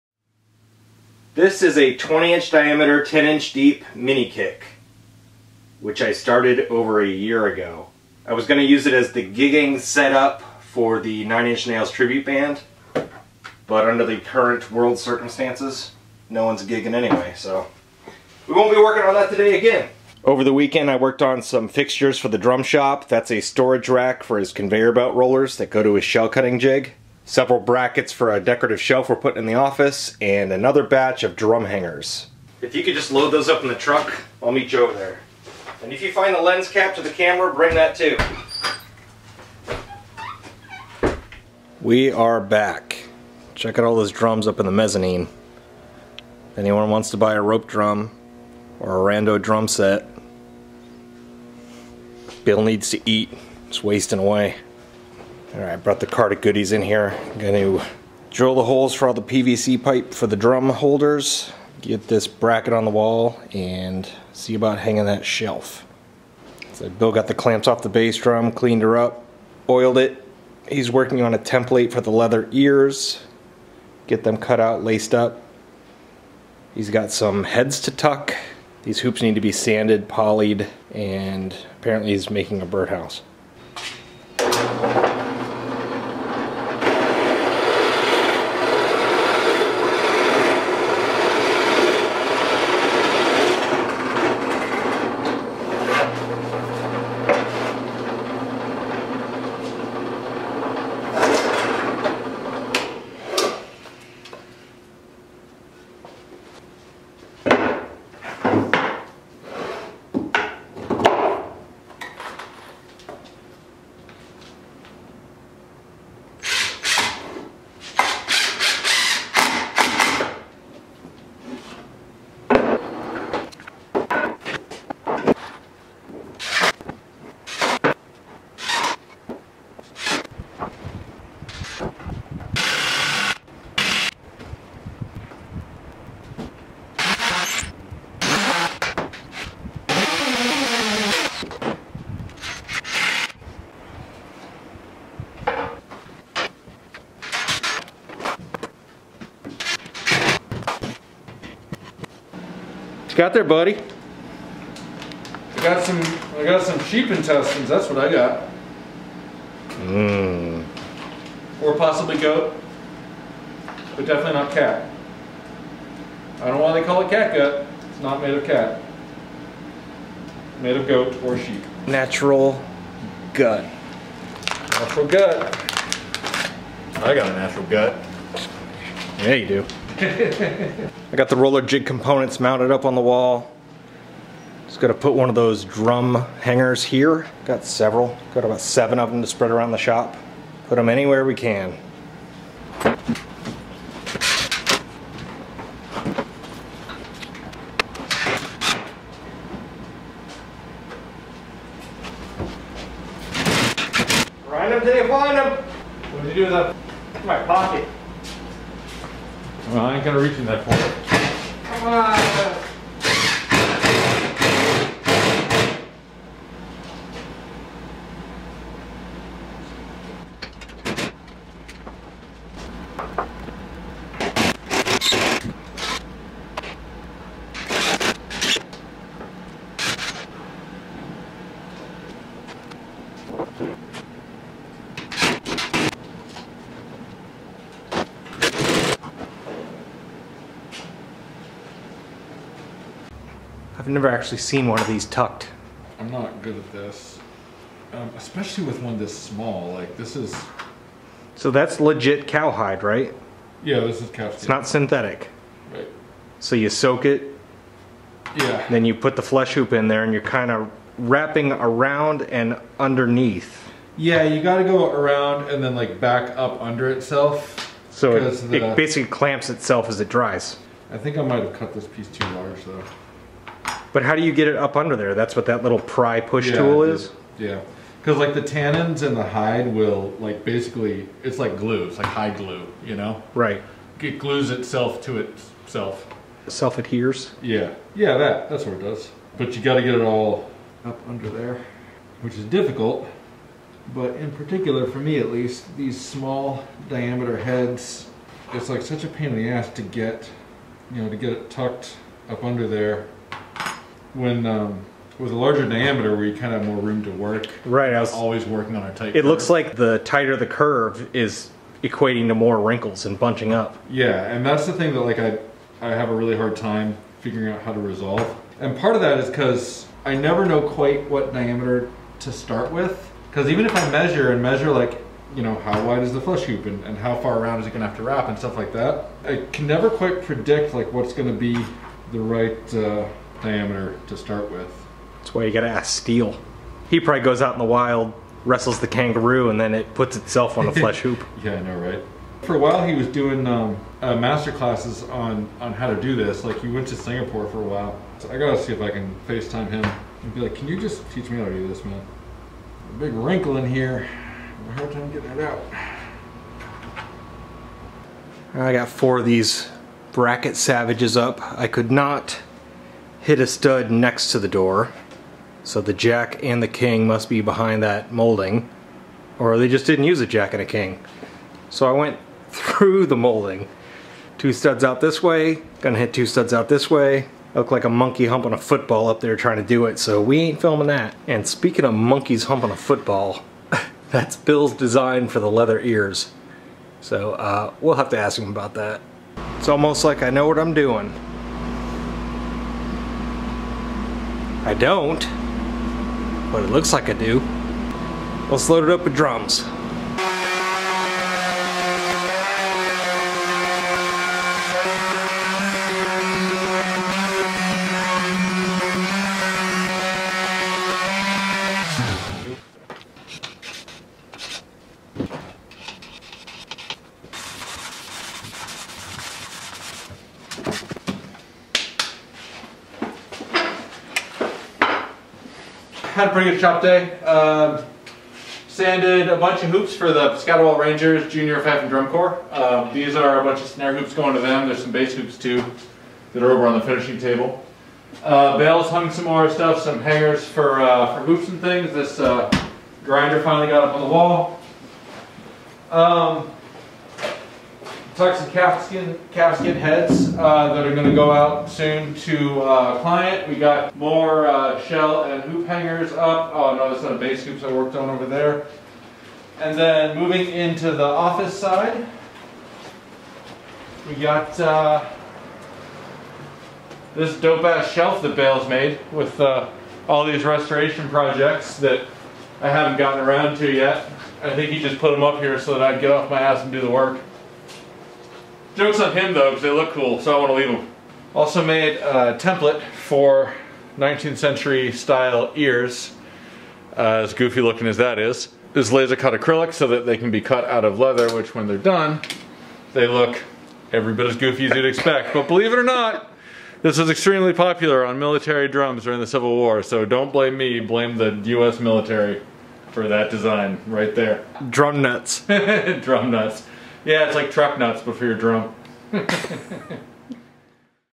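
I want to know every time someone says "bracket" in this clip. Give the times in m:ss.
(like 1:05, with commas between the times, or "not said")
0:27, 1:02, 6:00.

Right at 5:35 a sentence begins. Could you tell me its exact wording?
That's why you gotta ask Steel.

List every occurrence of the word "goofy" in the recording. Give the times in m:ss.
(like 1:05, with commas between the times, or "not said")
8:07, 8:14.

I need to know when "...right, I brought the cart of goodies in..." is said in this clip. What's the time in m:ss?
0:55.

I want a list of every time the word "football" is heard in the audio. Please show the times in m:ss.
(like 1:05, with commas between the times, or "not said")
6:18, 6:22.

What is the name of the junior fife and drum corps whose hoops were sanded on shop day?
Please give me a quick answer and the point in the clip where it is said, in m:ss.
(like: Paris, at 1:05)
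Scatterwall Rangers, at 7:10.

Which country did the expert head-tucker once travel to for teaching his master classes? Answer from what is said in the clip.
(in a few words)
Singapore.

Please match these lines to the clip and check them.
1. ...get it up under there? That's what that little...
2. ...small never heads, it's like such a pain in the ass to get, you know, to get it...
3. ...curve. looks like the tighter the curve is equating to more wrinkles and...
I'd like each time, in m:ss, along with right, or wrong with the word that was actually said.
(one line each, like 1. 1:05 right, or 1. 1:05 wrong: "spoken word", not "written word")
1. 4:34 right
2. 4:55 wrong: "diameter", not "never"
3. 5:09 right.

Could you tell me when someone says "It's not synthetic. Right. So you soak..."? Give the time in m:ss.
4:14.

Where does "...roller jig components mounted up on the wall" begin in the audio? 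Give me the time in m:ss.
3:01.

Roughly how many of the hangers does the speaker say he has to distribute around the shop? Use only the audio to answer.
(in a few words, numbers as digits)
7.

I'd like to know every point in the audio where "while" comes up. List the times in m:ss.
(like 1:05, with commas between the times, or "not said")
5:42, 5:47.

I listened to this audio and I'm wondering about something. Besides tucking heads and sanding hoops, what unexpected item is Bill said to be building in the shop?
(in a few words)
A birdhouse.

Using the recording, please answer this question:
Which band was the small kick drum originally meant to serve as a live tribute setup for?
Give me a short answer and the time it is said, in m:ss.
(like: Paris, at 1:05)
Nine Inch Nails, at 0:11.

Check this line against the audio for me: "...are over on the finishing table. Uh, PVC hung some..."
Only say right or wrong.
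wrong.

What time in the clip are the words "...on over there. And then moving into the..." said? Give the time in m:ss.
7:37.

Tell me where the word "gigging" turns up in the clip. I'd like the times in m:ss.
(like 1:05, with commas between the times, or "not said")
0:09, 0:16.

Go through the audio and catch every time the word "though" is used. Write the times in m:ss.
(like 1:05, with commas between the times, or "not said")
4:32, 7:59.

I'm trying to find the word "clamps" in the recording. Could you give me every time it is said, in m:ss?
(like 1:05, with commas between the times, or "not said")
1:07, 4:29.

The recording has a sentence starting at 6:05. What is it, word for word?
So the jack and the king must be behind that molding.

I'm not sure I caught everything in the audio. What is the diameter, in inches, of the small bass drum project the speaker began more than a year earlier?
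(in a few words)
20.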